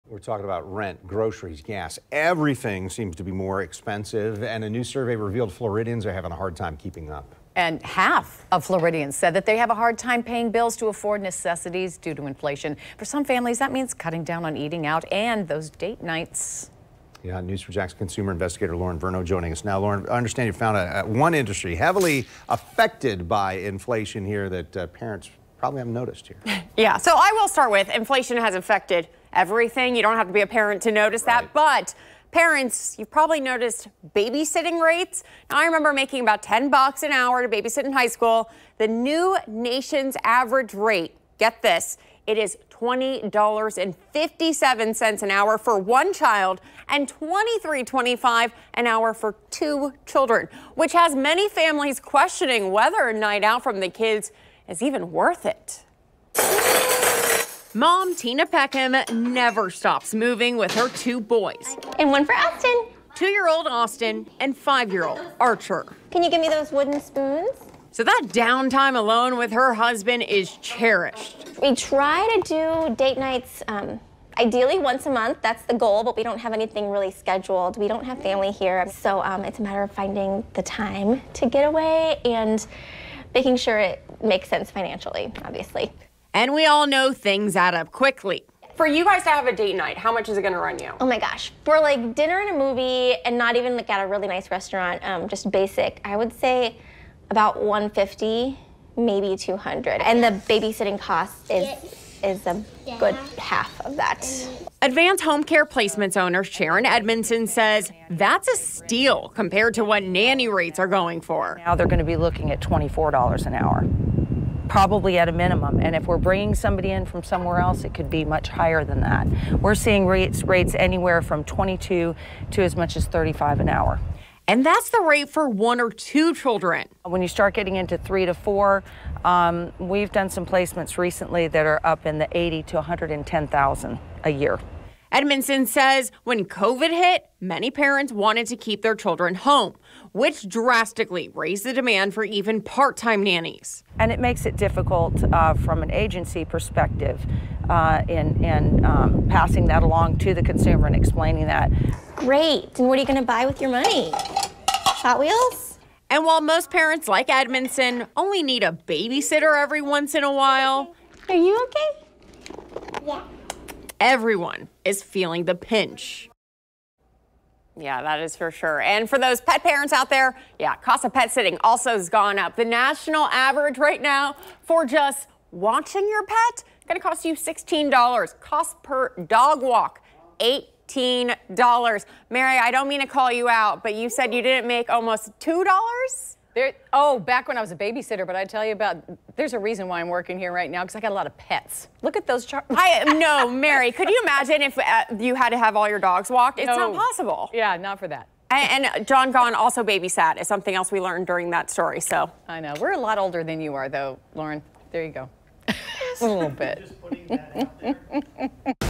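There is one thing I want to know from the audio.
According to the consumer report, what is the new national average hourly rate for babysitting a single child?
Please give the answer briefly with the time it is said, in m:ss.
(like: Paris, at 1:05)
$20.57, at 0:42.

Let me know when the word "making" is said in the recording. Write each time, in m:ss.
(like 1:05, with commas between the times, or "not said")
0:35, 1:23.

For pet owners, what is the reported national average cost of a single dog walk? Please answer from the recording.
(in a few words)
$18.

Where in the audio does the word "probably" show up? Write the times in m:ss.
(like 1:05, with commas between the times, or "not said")
0:25, 0:33, 1:54.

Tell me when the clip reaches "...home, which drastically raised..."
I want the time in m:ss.
2:19.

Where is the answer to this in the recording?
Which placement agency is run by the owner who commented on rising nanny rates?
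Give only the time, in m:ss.
1:44.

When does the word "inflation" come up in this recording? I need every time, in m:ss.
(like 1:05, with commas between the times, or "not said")
0:12, 0:23, 0:27.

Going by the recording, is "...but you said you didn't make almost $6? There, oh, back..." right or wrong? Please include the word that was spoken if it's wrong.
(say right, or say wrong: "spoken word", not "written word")
wrong: "2", not "6".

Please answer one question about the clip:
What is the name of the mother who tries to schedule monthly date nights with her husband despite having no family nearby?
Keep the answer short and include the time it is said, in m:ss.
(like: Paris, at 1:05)
Tina Peckham, at 0:58.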